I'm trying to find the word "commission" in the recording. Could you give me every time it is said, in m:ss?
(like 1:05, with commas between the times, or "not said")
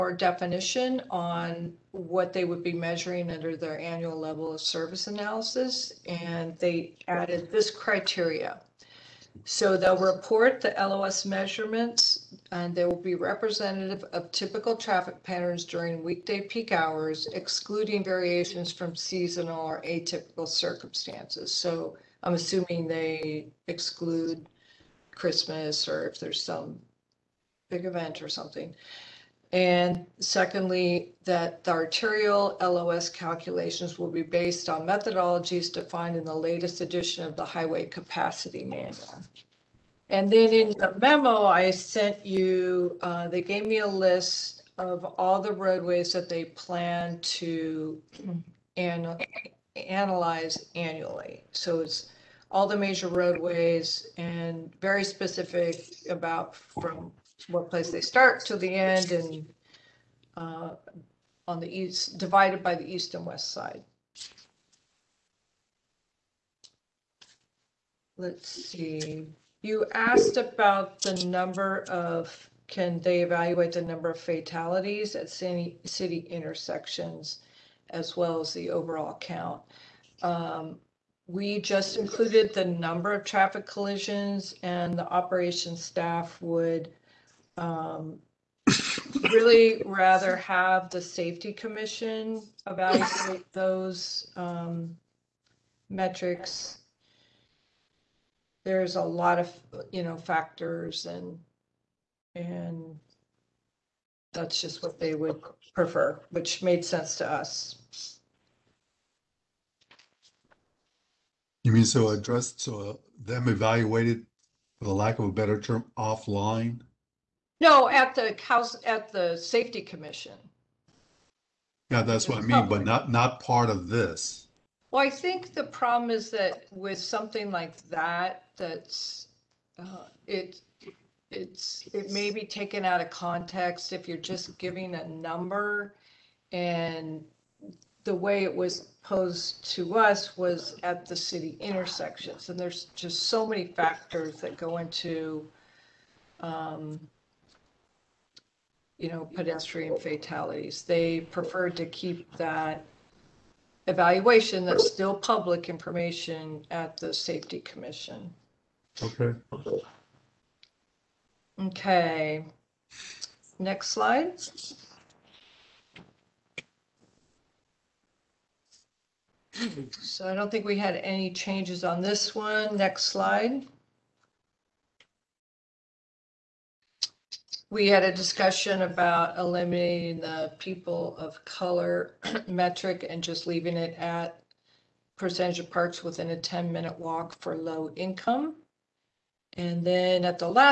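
1:31, 1:59, 2:37.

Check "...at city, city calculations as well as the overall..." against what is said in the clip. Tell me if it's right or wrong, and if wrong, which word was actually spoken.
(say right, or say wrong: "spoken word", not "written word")
wrong: "intersections", not "calculations".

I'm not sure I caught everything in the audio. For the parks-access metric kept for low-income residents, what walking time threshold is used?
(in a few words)
10 minutes.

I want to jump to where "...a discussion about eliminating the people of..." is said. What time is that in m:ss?
2:58.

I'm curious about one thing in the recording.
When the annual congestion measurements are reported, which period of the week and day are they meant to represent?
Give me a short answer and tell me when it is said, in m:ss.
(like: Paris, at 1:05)
weekday peak hours, at 0:16.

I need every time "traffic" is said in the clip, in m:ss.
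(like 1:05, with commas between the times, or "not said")
0:14, 1:23.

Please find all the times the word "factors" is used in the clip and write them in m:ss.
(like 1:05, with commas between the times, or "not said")
1:40, 2:23.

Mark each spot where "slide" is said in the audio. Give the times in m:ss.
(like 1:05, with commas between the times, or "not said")
2:43, 2:53.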